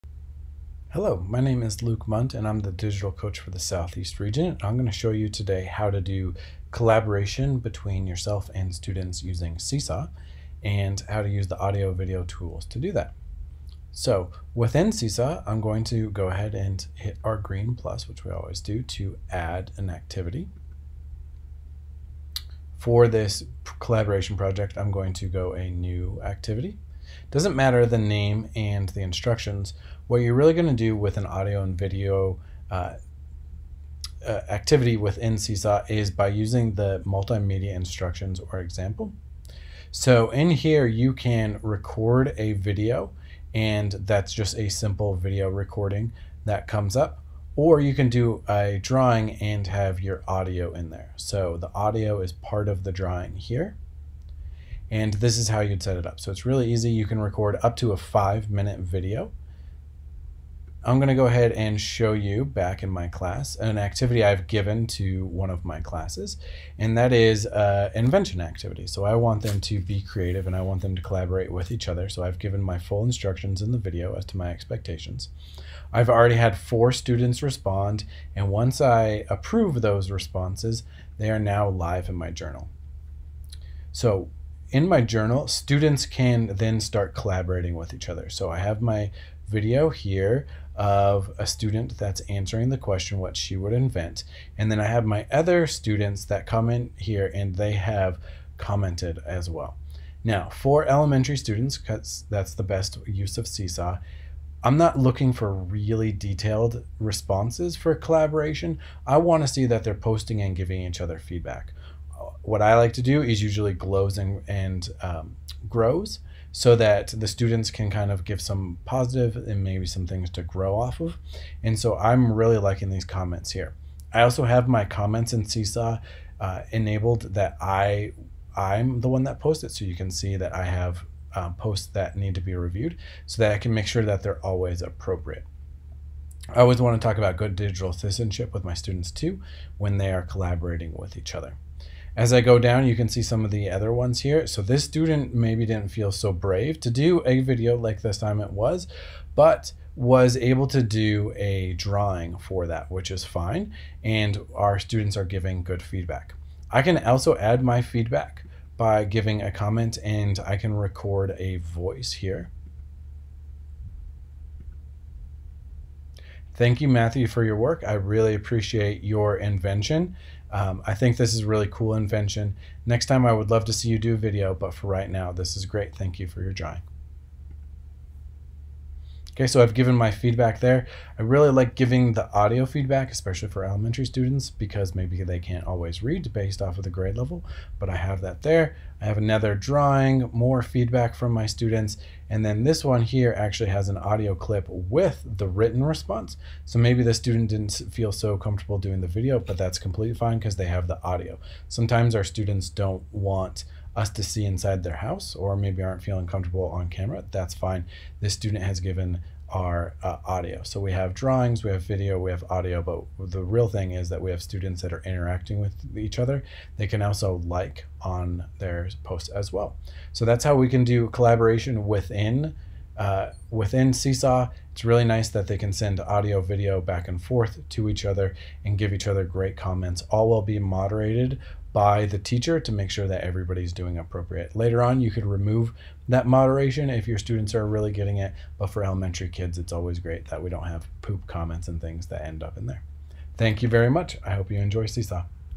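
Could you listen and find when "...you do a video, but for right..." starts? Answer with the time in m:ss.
2:53.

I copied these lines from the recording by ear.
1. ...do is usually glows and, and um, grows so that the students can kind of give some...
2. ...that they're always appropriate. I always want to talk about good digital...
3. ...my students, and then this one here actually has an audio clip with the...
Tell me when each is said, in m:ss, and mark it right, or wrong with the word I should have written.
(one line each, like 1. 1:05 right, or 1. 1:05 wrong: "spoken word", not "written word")
1. 1:53 right
2. 2:14 right
3. 3:11 right.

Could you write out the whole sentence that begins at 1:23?
So in my journal, students can then start collaborating with each other.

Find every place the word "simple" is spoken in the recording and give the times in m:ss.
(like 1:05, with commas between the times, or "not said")
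0:44.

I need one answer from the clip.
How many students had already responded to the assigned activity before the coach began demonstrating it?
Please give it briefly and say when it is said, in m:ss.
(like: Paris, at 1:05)
4, at 1:16.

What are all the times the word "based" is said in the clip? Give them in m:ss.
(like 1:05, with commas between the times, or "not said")
3:06.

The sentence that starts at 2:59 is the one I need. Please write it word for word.
Okay, so I've given my feedback there.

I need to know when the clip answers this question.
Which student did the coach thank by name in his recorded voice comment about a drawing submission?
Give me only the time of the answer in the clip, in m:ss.
2:46.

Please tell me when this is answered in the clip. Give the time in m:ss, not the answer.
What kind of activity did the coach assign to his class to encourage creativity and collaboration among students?
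1:07.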